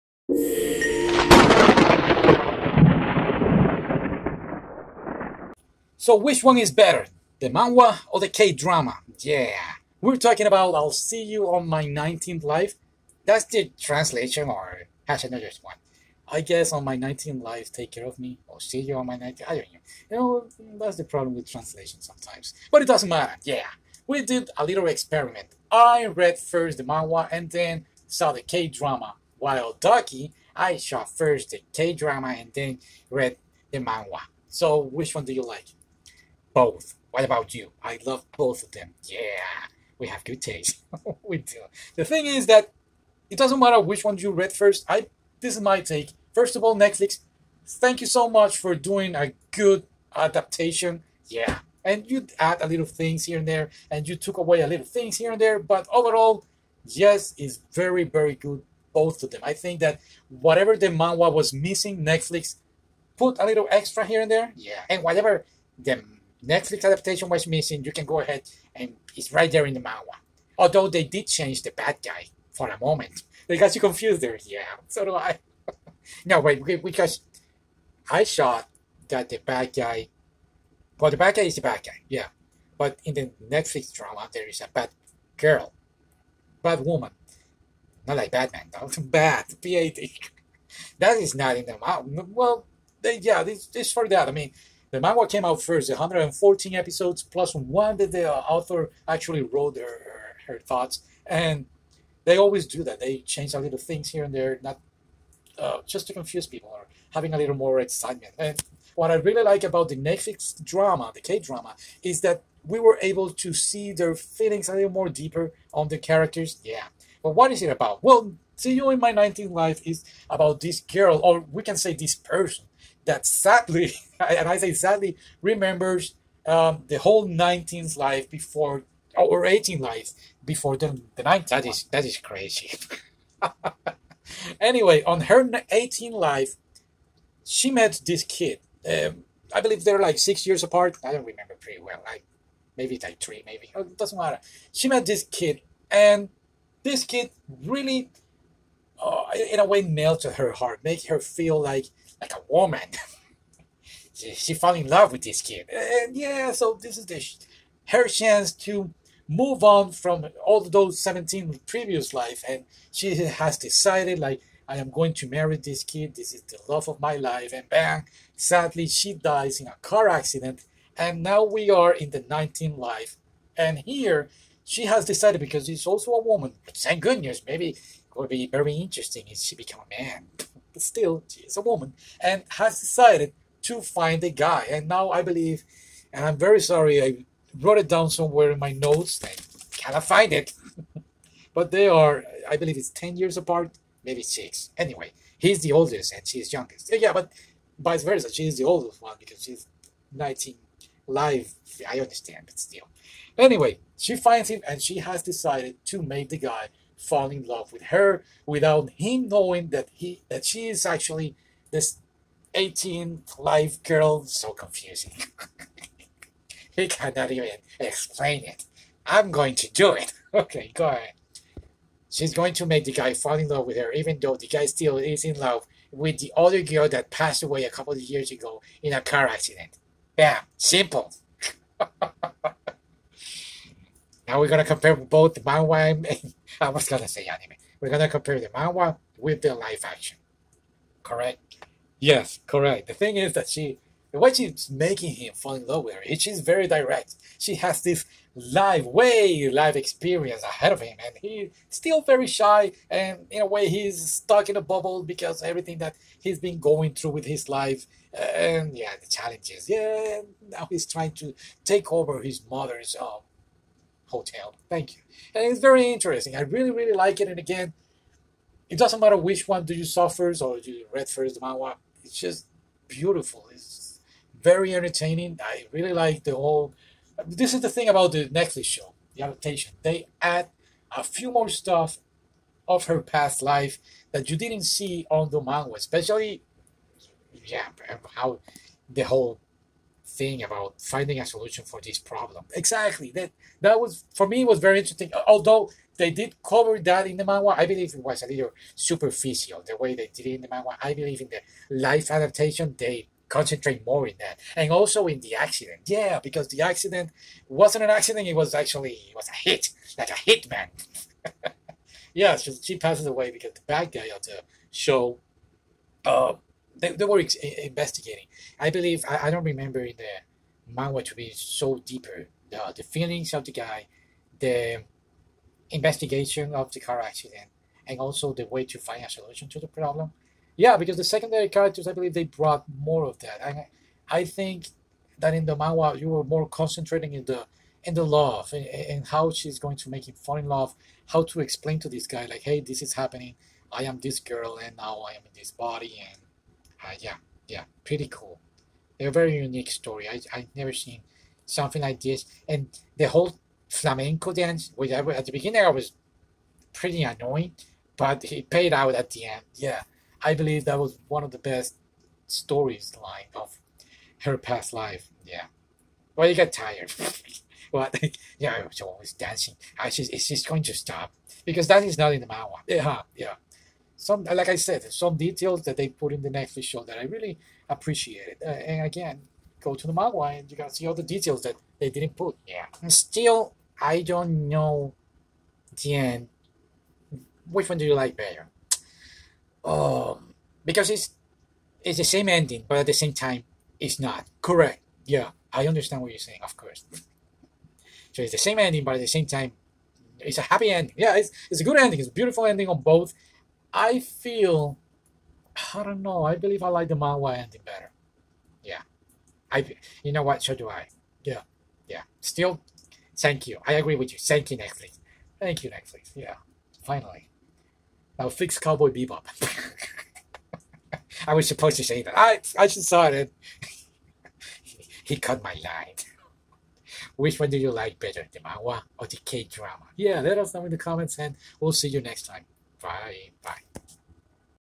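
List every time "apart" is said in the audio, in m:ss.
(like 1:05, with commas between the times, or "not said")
2:20, 3:13.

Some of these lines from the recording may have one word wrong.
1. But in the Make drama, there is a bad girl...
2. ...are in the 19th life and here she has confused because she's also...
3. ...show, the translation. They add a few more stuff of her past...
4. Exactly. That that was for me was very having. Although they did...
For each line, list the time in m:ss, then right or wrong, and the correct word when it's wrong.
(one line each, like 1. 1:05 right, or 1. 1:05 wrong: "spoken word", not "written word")
1. 1:22 wrong: "Netflix", not "Make"
2. 2:51 wrong: "decided", not "confused"
3. 4:38 wrong: "adaptation", not "translation"
4. 4:52 wrong: "interesting", not "having".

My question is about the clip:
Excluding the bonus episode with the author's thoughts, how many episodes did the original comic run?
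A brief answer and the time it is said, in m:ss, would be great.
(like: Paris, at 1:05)
114, at 1:35.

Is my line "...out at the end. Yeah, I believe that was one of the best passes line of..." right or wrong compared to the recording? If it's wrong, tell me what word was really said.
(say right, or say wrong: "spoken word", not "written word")
wrong: "stories", not "passes".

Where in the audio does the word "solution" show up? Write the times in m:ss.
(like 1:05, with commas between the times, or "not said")
4:51, 5:29.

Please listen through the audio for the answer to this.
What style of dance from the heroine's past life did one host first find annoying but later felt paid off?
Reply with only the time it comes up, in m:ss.
5:53.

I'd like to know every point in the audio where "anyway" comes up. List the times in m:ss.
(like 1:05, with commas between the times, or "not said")
2:14, 3:14, 3:23.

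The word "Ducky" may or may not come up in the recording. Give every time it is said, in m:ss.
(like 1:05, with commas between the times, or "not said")
0:29.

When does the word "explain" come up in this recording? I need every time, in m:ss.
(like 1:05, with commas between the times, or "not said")
3:37, 5:41.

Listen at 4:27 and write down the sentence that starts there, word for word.
And again, it doesn't matter which one do you saw first or you read first the manhwa.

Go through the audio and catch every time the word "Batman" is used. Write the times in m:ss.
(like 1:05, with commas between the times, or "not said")
1:28.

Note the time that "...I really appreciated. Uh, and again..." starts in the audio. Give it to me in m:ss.
6:16.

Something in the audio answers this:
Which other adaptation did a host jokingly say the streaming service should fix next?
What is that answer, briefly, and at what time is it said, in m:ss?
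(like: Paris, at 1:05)
Cowboy Bebop, at 6:58.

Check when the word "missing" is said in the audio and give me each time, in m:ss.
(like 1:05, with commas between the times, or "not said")
1:01, 1:07.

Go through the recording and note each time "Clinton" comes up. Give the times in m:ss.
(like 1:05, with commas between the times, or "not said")
not said.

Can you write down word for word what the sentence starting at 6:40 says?
Yeah, it's it's a good ending.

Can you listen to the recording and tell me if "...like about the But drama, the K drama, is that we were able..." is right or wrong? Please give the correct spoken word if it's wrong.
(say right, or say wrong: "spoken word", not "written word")
wrong: "Netflix", not "But".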